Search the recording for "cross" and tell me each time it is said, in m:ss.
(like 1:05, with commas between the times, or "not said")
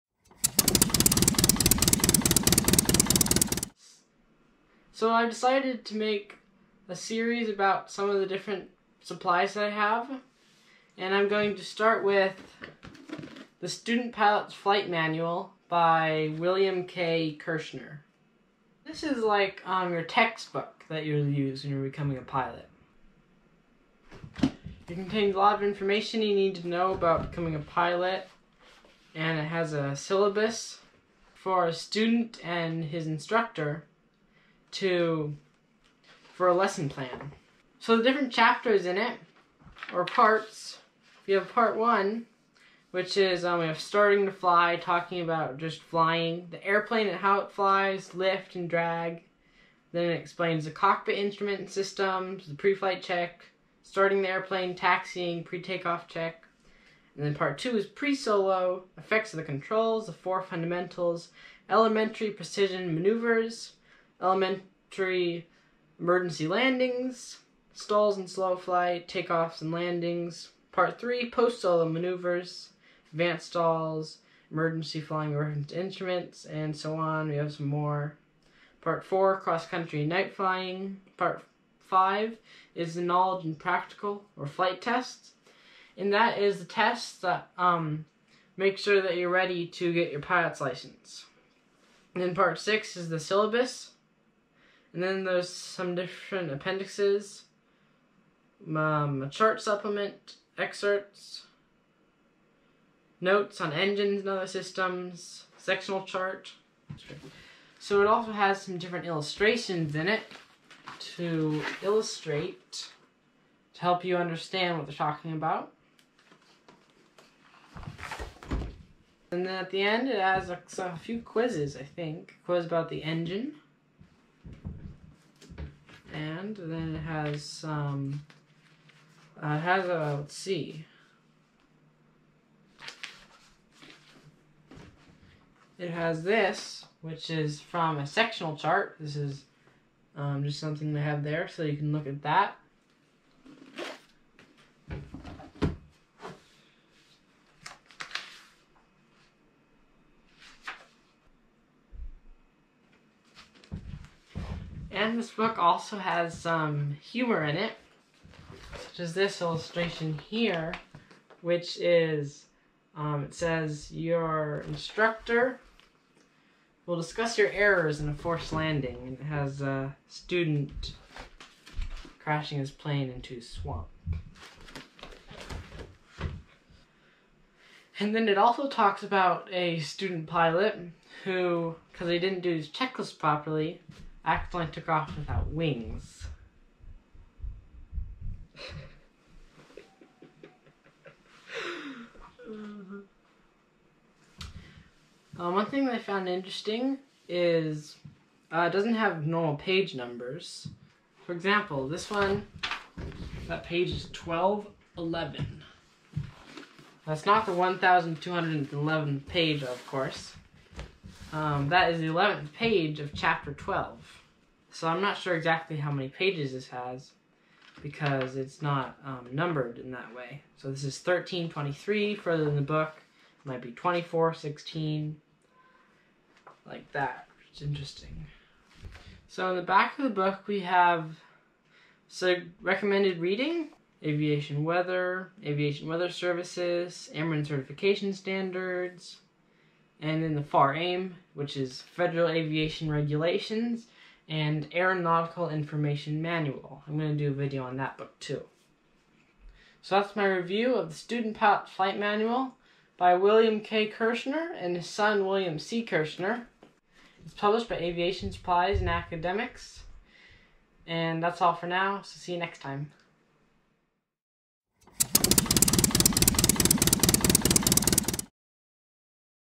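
1:19.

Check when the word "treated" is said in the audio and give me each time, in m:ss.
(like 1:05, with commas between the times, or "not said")
not said.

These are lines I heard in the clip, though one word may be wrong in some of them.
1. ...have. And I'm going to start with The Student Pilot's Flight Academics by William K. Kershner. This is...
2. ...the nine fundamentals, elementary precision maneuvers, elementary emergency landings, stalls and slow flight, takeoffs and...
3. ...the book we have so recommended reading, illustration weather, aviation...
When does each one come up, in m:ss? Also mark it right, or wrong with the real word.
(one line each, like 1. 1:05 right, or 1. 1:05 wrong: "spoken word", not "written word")
1. 0:09 wrong: "Manual", not "Academics"
2. 1:00 wrong: "four", not "nine"
3. 3:50 wrong: "aviation", not "illustration".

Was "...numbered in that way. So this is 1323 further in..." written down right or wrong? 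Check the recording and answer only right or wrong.
right.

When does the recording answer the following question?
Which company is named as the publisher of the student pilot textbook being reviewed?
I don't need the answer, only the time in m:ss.
4:17.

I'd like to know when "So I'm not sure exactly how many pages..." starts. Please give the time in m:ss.
3:34.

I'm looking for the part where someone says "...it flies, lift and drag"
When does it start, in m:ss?
0:47.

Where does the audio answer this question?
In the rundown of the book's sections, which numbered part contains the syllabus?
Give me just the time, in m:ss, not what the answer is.
1:32.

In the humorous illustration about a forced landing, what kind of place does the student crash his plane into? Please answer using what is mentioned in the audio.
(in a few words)
a swamp.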